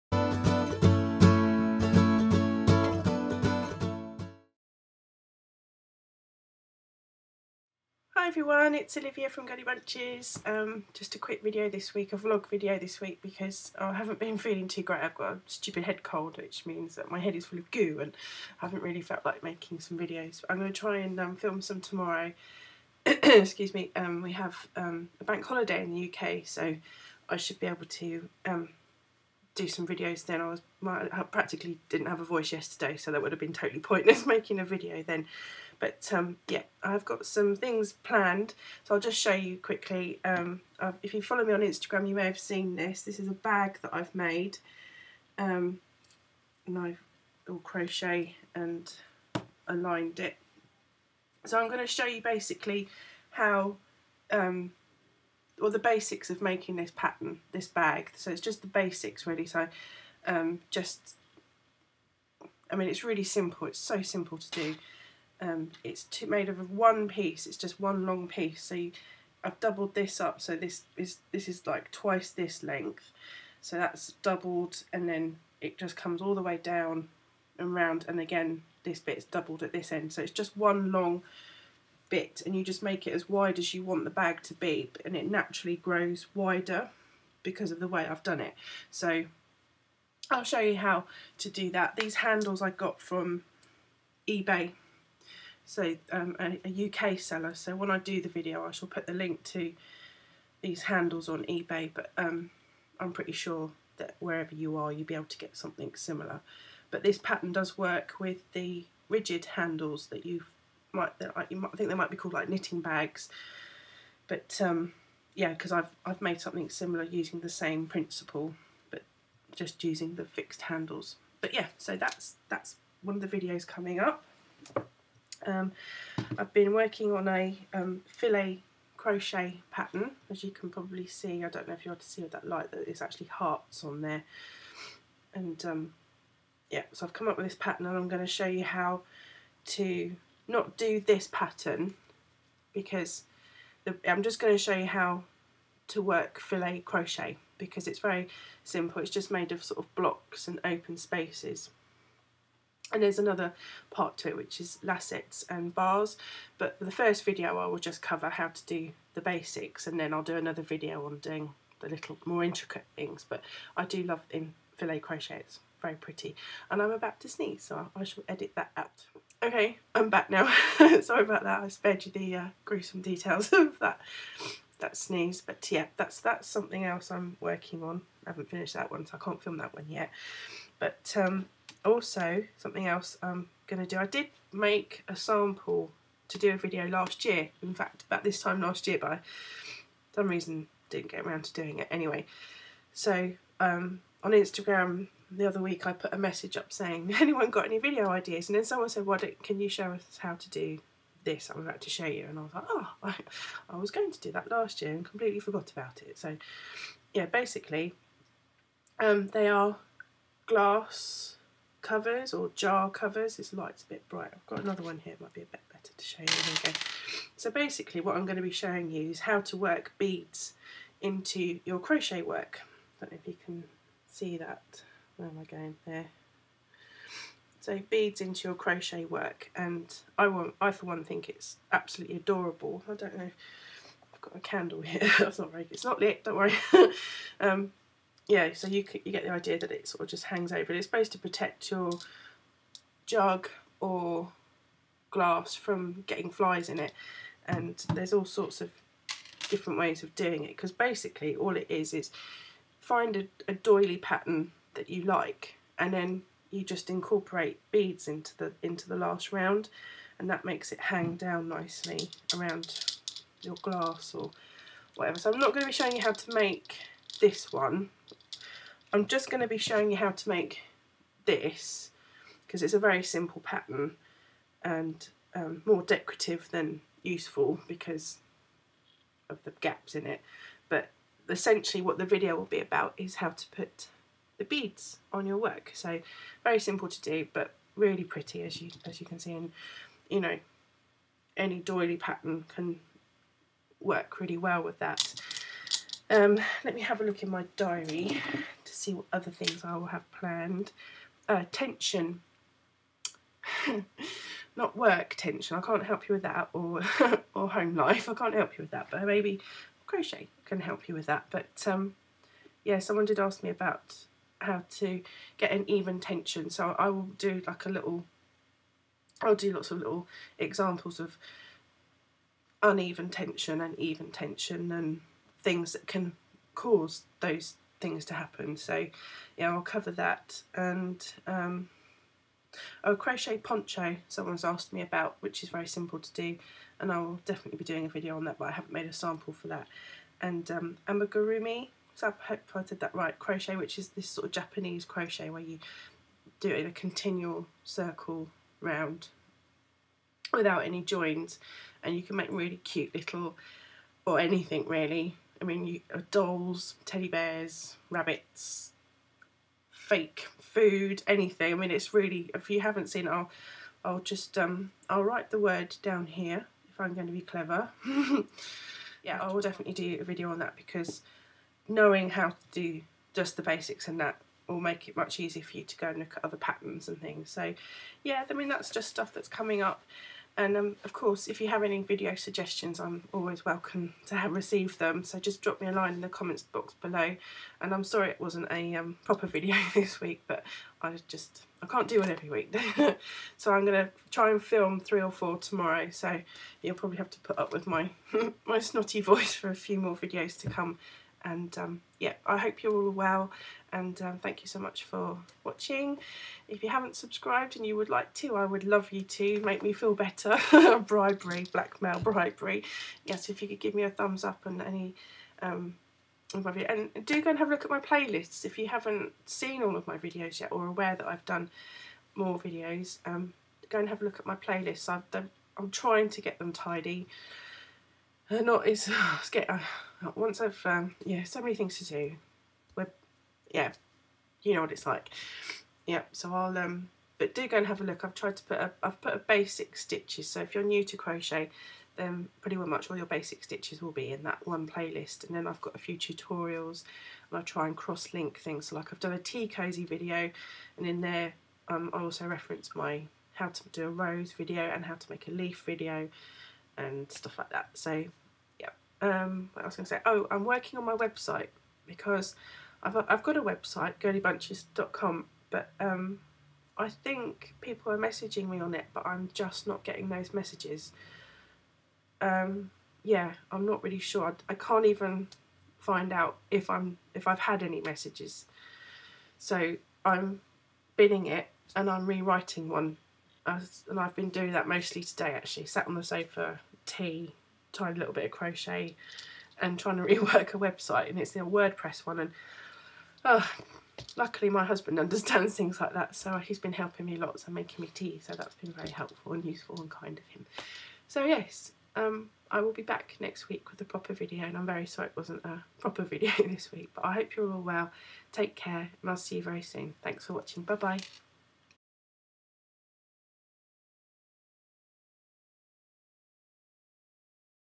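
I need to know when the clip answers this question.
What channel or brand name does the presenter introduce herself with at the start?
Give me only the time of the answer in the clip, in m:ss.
0:09.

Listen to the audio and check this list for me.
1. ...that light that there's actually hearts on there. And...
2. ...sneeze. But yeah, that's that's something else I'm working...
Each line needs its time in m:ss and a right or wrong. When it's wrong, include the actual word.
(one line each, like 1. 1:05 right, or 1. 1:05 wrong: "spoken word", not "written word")
1. 2:12 right
2. 2:54 right.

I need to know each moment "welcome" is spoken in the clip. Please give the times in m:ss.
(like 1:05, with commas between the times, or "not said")
6:23.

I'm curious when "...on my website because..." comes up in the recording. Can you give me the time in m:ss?
7:40.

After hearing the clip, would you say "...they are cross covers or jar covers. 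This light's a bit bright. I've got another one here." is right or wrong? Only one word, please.
wrong.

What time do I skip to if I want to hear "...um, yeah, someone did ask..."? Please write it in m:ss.
5:11.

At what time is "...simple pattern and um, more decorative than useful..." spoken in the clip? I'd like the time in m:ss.
4:33.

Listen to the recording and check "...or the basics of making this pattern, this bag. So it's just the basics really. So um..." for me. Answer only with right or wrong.
right.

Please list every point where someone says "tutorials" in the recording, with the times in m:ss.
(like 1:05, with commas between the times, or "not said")
7:25.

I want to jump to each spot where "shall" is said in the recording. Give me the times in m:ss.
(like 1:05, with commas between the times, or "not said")
1:38, 2:48.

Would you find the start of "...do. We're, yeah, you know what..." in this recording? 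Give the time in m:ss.
7:11.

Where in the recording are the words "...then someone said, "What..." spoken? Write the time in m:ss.
3:18.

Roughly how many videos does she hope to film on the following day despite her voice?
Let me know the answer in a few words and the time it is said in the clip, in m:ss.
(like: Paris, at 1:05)
3 or 4, at 6:34.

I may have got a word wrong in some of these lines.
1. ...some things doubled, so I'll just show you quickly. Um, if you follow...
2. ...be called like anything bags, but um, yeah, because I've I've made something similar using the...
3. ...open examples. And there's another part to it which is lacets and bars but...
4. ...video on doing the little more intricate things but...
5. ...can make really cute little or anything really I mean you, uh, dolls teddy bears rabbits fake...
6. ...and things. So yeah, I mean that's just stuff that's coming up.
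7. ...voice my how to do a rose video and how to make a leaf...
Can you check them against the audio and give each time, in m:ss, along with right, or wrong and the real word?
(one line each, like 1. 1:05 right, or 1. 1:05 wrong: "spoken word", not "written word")
1. 0:37 wrong: "planned", not "doubled"
2. 1:52 wrong: "knitting", not "anything"
3. 2:30 wrong: "spaces", not "examples"
4. 2:40 right
5. 5:52 right
6. 6:16 right
7. 7:32 wrong: "reference", not "voice".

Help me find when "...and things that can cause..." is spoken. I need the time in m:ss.
5:24.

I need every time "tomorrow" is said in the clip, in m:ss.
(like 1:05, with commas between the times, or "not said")
0:21, 6:35.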